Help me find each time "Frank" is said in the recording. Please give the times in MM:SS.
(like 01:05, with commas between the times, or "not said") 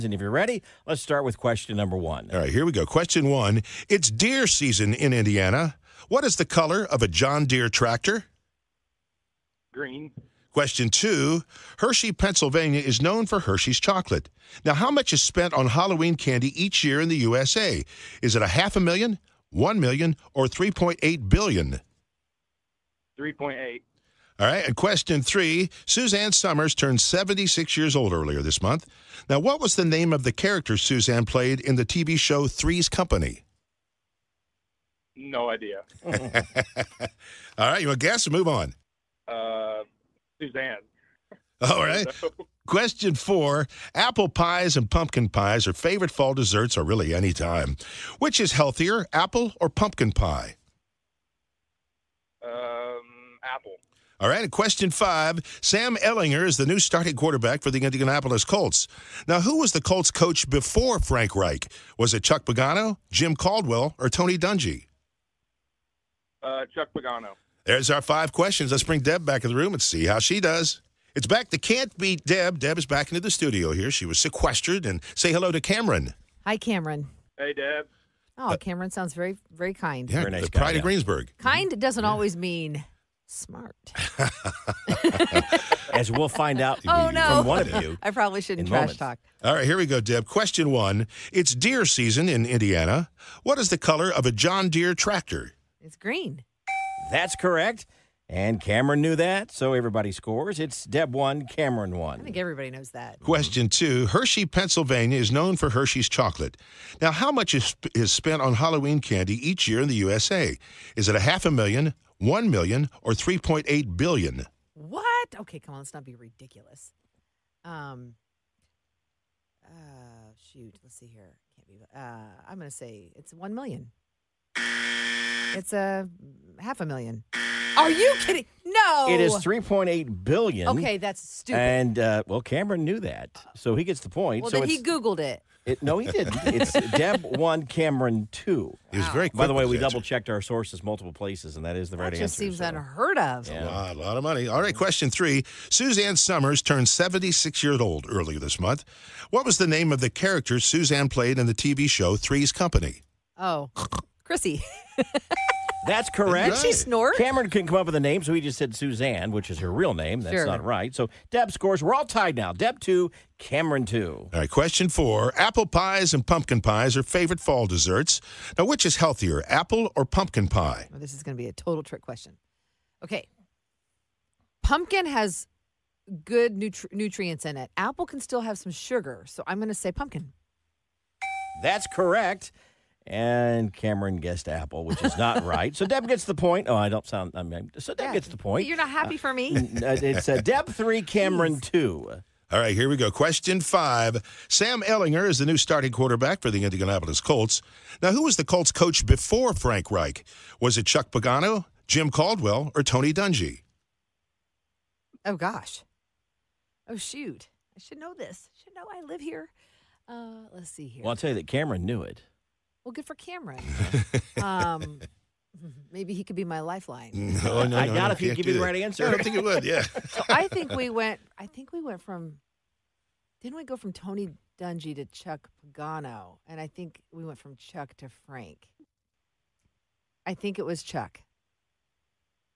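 01:00, 03:19, 03:48.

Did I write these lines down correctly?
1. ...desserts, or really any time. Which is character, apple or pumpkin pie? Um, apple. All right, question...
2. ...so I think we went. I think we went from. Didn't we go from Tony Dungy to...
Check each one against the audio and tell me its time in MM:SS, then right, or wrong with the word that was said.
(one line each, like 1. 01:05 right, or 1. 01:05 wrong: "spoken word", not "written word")
1. 00:46 wrong: "healthier", not "character"
2. 03:40 right.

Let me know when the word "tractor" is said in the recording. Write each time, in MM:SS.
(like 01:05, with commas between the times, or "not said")
00:07, 01:34.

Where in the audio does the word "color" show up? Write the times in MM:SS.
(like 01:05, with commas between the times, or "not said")
00:06, 01:33.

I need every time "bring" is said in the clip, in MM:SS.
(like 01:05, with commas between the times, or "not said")
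01:08.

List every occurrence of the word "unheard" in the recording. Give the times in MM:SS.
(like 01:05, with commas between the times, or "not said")
02:22.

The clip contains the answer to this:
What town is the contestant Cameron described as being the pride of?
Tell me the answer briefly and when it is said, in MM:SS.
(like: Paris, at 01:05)
Greensburg, at 01:20.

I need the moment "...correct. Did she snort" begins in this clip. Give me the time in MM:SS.
02:36.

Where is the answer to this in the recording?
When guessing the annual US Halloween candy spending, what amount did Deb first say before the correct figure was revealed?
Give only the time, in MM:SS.
02:03.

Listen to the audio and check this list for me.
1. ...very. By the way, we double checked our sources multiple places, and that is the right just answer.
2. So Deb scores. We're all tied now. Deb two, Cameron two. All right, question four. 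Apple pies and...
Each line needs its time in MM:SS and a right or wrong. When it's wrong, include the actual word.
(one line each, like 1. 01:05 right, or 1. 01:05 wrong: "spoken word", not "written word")
1. 02:19 right
2. 02:40 right.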